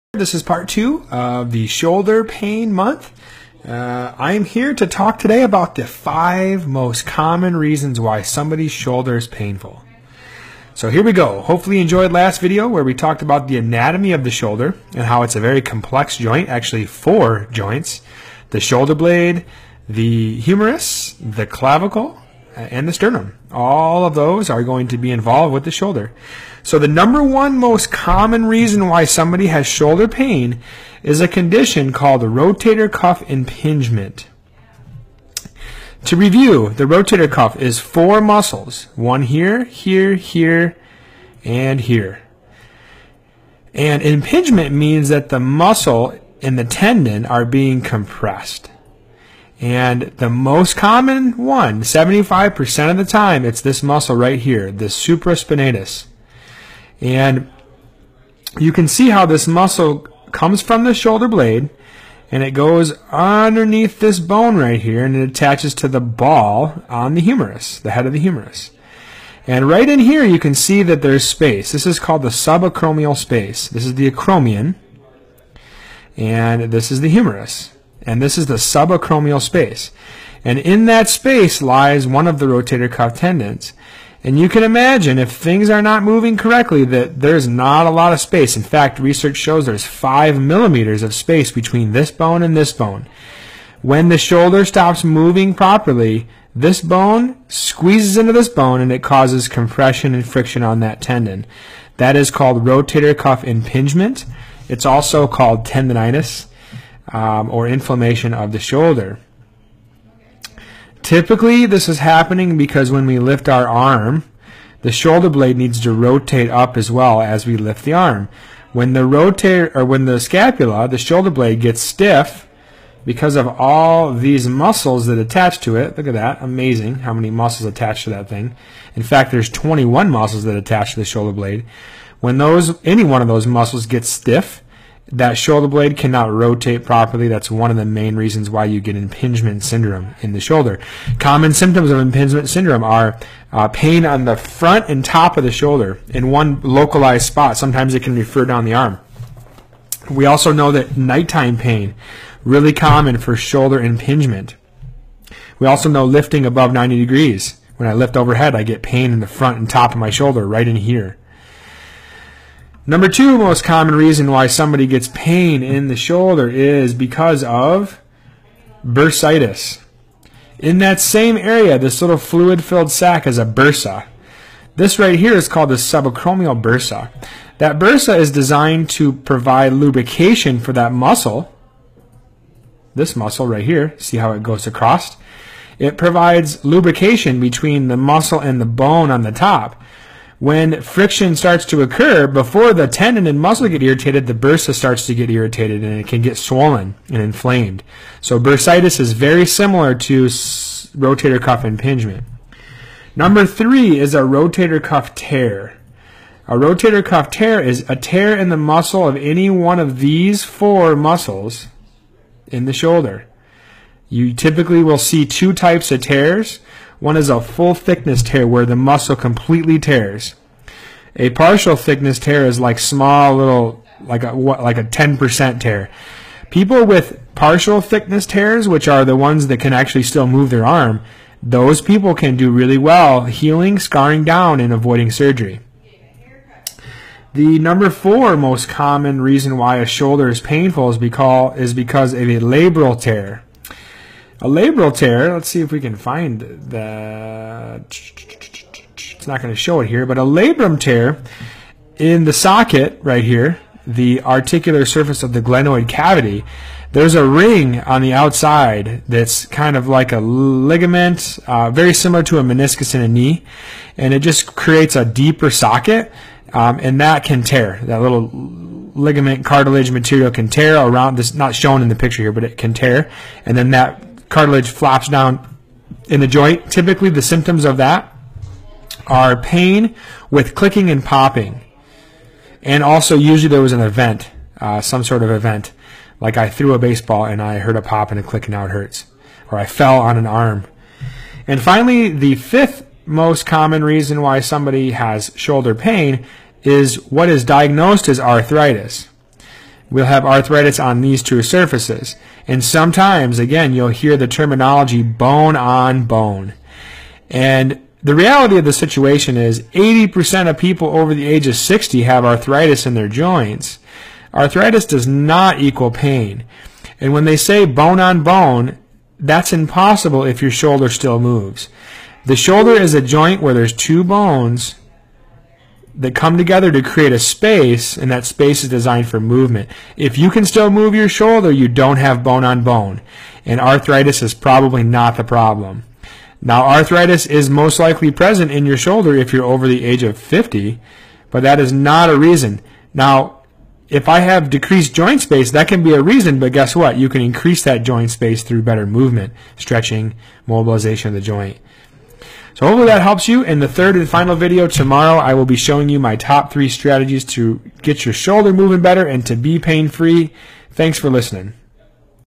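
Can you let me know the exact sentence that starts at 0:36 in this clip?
To review, the rotator cuff is four muscles, one here, here, here, and here.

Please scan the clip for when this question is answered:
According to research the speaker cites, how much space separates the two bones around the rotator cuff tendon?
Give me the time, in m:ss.
1:29.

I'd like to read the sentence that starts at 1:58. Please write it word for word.
When the rotator or when the scapula, the shoulder blade gets stiff because of all these muscles that attach to it.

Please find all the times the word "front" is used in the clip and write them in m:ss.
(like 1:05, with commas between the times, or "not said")
2:24, 2:39.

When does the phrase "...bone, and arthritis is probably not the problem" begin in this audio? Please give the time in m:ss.
5:32.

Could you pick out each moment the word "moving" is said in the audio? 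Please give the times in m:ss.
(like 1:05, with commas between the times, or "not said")
1:26, 1:35, 5:58.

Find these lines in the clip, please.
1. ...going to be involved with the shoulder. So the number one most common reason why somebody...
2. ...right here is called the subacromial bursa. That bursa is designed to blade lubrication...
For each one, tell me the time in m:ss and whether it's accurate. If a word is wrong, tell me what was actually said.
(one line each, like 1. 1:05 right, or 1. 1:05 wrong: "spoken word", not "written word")
1. 0:24 right
2. 2:54 wrong: "provide", not "blade".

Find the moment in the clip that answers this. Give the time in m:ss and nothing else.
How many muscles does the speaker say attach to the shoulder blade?
2:09.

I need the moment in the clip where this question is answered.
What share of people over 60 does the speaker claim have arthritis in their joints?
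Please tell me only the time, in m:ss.
5:09.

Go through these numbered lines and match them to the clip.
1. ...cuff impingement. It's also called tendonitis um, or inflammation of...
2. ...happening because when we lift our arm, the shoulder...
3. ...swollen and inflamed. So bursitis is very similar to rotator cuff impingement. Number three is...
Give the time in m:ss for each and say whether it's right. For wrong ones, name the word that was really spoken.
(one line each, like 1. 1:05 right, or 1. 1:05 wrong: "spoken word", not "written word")
1. 1:43 right
2. 1:51 right
3. 3:16 right.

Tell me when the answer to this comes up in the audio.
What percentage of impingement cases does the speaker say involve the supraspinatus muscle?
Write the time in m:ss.
0:51.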